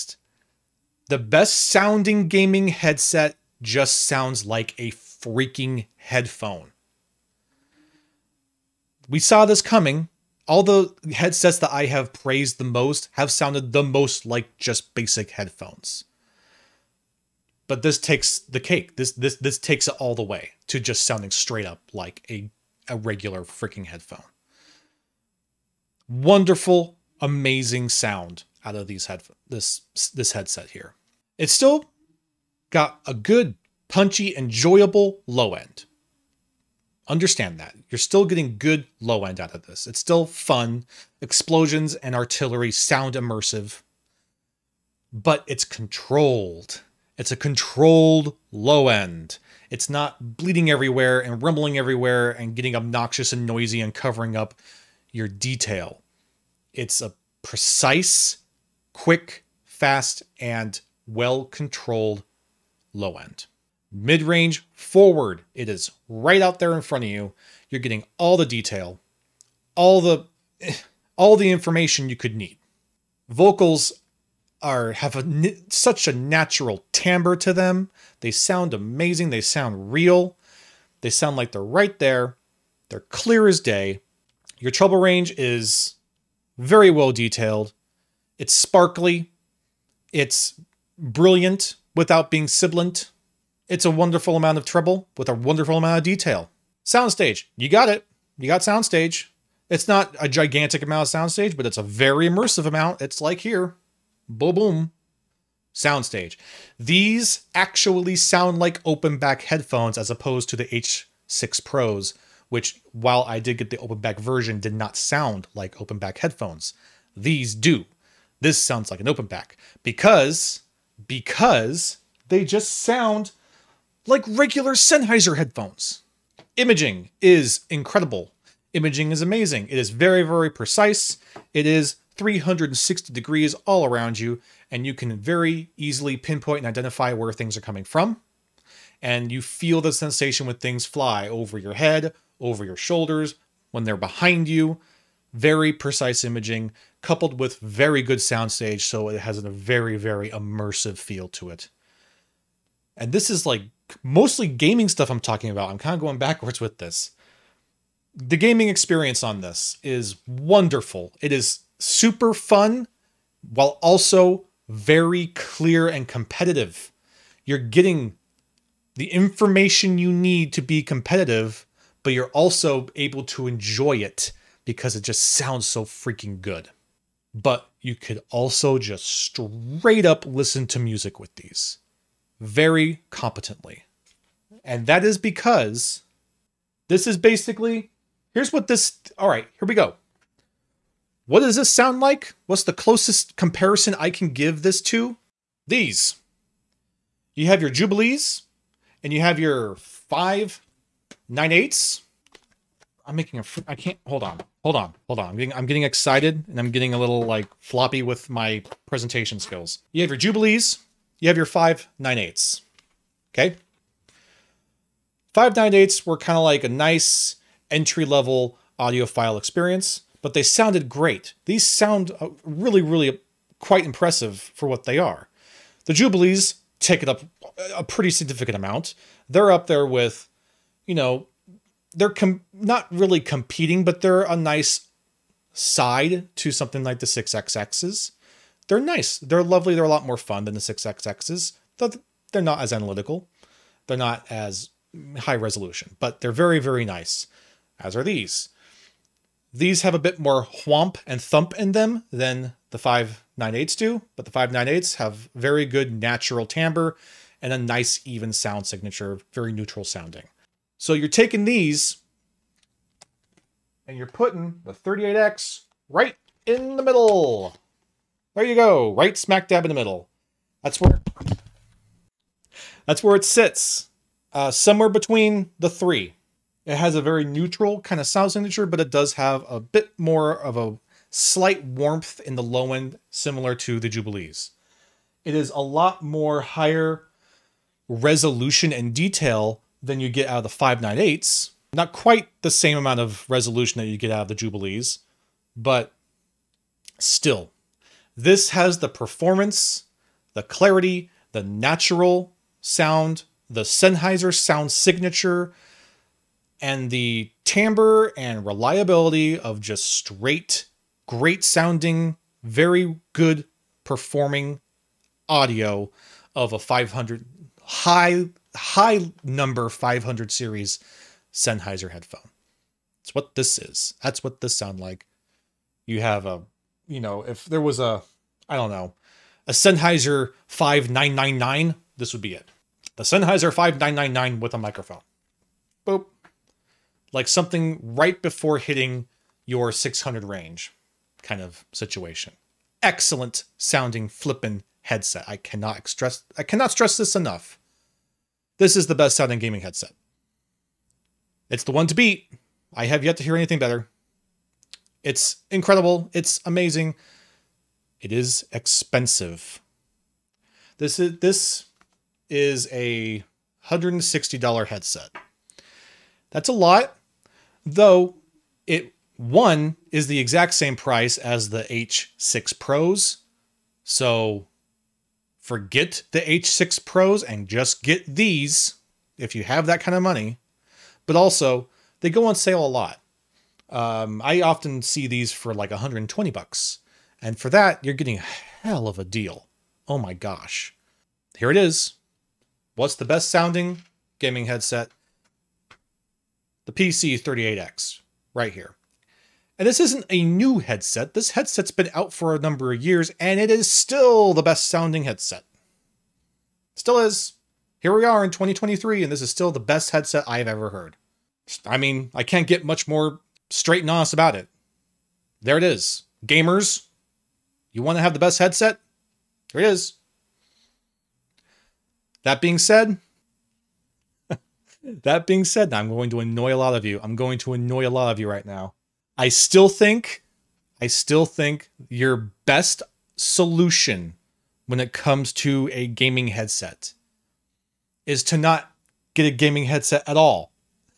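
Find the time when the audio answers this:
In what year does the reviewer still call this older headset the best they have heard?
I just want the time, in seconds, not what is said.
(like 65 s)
408 s.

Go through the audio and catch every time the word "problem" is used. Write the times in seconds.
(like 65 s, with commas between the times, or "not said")
not said.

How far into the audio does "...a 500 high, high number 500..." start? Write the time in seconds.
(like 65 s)
316 s.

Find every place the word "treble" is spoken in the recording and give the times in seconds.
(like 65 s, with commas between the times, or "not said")
84 s, 94 s.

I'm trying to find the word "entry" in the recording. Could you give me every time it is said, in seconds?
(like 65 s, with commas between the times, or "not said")
217 s.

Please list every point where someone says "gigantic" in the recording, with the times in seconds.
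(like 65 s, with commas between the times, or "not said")
100 s.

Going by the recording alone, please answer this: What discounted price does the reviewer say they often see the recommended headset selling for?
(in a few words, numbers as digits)
$120.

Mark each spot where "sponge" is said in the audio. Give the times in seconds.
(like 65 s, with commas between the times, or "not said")
not said.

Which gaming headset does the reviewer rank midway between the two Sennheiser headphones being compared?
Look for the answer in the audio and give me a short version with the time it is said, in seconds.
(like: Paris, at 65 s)
38X, at 264 s.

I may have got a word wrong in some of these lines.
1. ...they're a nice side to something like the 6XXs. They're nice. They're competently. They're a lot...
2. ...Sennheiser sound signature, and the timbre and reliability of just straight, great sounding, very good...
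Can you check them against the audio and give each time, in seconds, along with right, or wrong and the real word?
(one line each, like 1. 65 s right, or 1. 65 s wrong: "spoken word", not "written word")
1. 234 s wrong: "lovely", not "competently"
2. 303 s right.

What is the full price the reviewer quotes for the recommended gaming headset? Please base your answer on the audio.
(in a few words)
$160.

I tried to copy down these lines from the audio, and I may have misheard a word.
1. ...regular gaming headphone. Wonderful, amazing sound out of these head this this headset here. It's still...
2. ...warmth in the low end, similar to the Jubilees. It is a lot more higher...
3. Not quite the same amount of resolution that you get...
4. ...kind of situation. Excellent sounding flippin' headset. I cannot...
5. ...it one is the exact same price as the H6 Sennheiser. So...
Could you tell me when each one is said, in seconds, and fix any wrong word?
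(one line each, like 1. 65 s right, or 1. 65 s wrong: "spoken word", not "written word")
1. 22 s wrong: "freaking", not "gaming"
2. 281 s right
3. 291 s right
4. 341 s right
5. 368 s wrong: "Pros", not "Sennheiser".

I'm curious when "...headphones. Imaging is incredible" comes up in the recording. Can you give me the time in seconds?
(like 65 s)
125 s.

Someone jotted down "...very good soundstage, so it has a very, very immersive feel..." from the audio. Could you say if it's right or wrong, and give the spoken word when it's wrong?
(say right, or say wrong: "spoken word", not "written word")
right.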